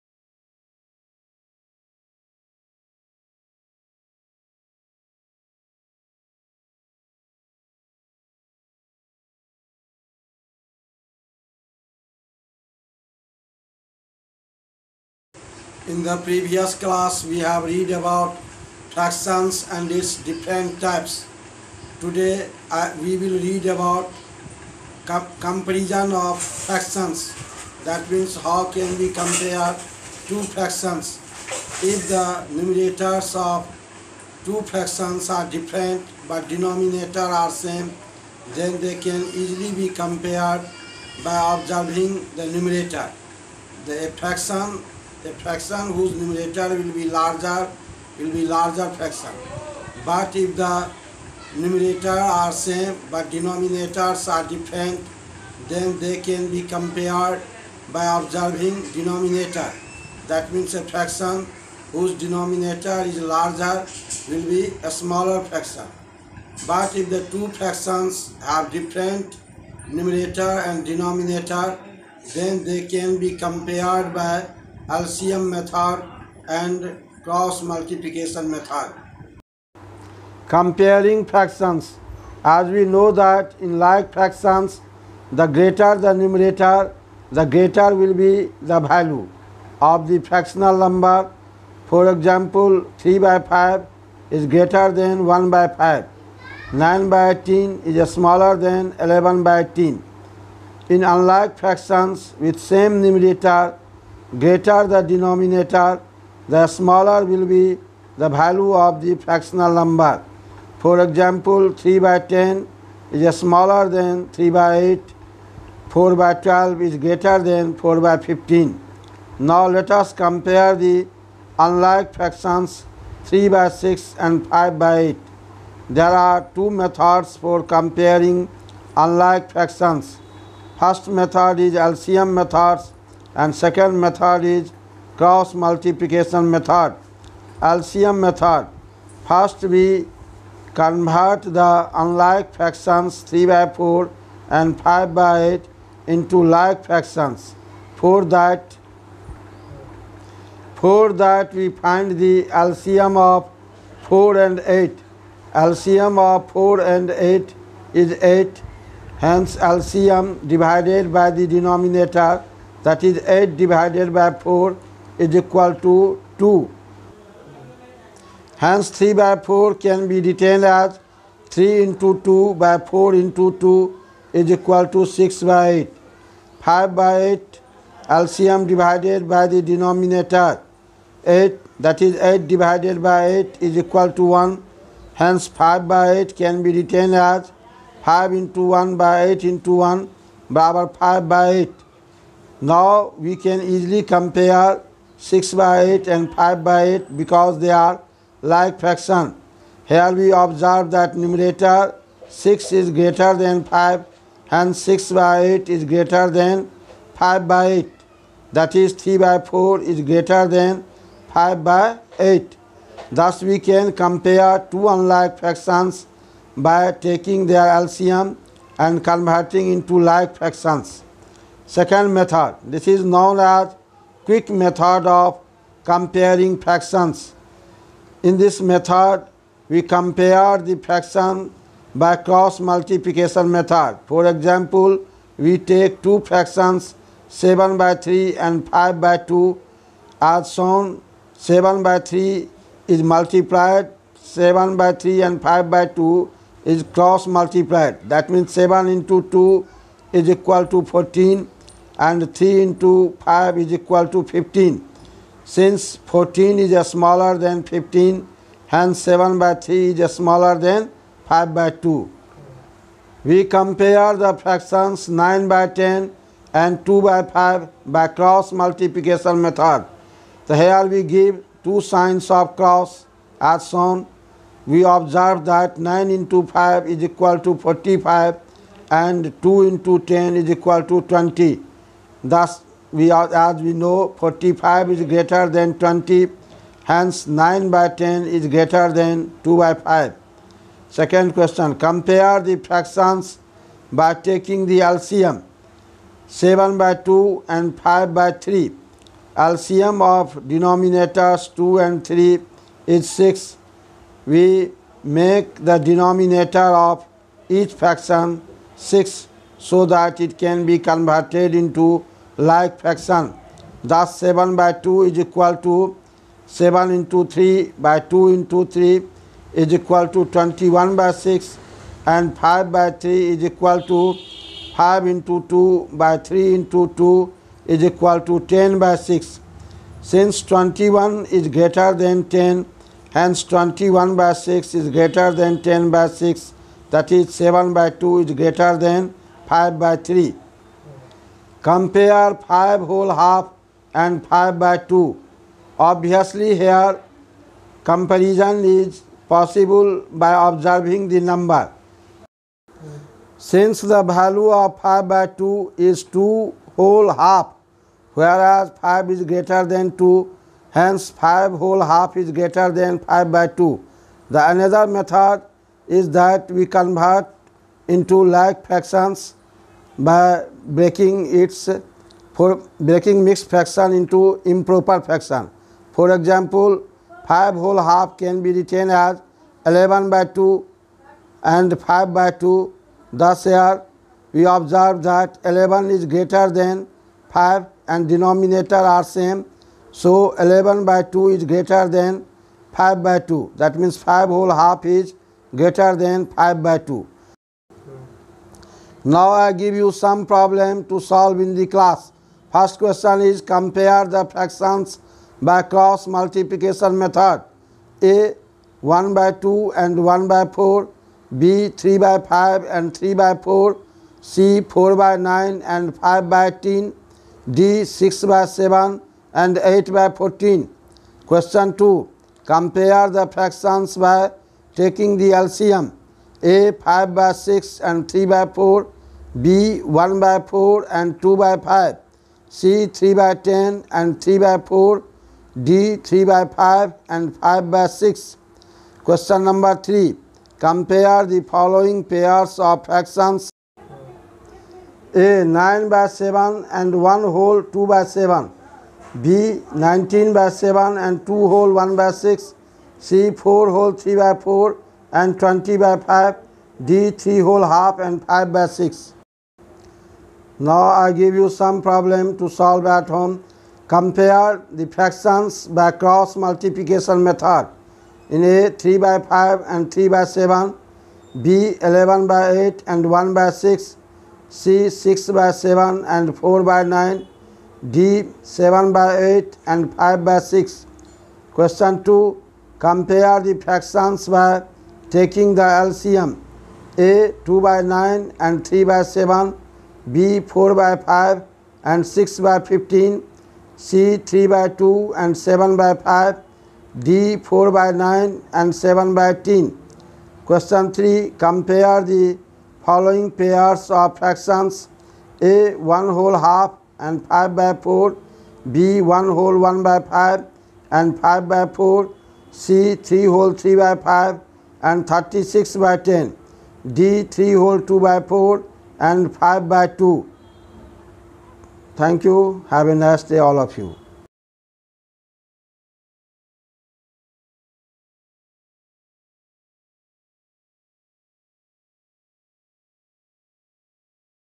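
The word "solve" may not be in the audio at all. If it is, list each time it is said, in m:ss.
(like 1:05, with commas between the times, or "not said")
6:40, 7:42.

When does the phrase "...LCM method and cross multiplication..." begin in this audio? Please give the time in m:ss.
1:14.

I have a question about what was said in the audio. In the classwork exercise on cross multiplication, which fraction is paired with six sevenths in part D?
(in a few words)
8/14.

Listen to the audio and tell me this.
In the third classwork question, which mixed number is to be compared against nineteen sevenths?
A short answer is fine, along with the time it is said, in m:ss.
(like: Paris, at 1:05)
2 1/6, at 7:31.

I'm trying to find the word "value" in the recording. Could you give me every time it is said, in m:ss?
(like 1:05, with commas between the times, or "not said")
1:28, 1:48, 5:54.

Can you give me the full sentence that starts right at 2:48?
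Hence 3 by 4 can be written as 3 into 2 by 4 into 2 is equal to 6 by 8.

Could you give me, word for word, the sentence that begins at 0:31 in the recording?
If the numerators of two fractions are different but denominator are same, then they can easily be compared by observing the numerator.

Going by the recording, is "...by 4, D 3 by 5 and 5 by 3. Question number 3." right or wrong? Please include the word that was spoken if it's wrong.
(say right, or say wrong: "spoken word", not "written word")
wrong: "6", not "3".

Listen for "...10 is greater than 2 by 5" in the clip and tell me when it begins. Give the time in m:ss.
4:47.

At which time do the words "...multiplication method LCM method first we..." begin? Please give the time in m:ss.
2:15.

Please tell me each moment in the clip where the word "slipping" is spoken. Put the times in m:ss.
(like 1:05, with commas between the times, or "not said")
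not said.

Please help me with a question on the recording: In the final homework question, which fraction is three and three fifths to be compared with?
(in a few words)
36/10.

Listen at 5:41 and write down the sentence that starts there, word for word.
Compare 5 whole half and 5 by 2.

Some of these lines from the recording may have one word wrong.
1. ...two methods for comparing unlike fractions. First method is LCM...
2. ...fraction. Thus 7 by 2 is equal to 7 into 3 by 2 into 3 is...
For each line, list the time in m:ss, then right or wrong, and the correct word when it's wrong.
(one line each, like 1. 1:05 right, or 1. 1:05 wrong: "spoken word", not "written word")
1. 2:06 right
2. 5:12 right.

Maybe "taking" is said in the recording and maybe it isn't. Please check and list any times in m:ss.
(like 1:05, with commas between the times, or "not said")
3:36, 4:54, 7:04, 8:05.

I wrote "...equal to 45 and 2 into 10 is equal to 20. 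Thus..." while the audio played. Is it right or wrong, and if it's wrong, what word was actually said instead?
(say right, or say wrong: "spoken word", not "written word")
right.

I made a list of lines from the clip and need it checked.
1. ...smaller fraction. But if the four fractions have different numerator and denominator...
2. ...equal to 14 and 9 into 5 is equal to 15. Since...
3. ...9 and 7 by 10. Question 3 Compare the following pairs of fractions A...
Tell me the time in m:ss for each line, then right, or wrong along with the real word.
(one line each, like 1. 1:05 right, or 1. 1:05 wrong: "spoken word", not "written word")
1. 1:04 wrong: "two", not "four"
2. 4:10 wrong: "3", not "9"
3. 8:17 right.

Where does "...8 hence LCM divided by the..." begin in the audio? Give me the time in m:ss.
2:38.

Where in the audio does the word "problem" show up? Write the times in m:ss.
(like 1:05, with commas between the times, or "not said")
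6:40, 7:41.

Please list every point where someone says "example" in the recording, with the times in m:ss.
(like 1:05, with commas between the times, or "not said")
1:32, 1:51, 3:54, 6:16.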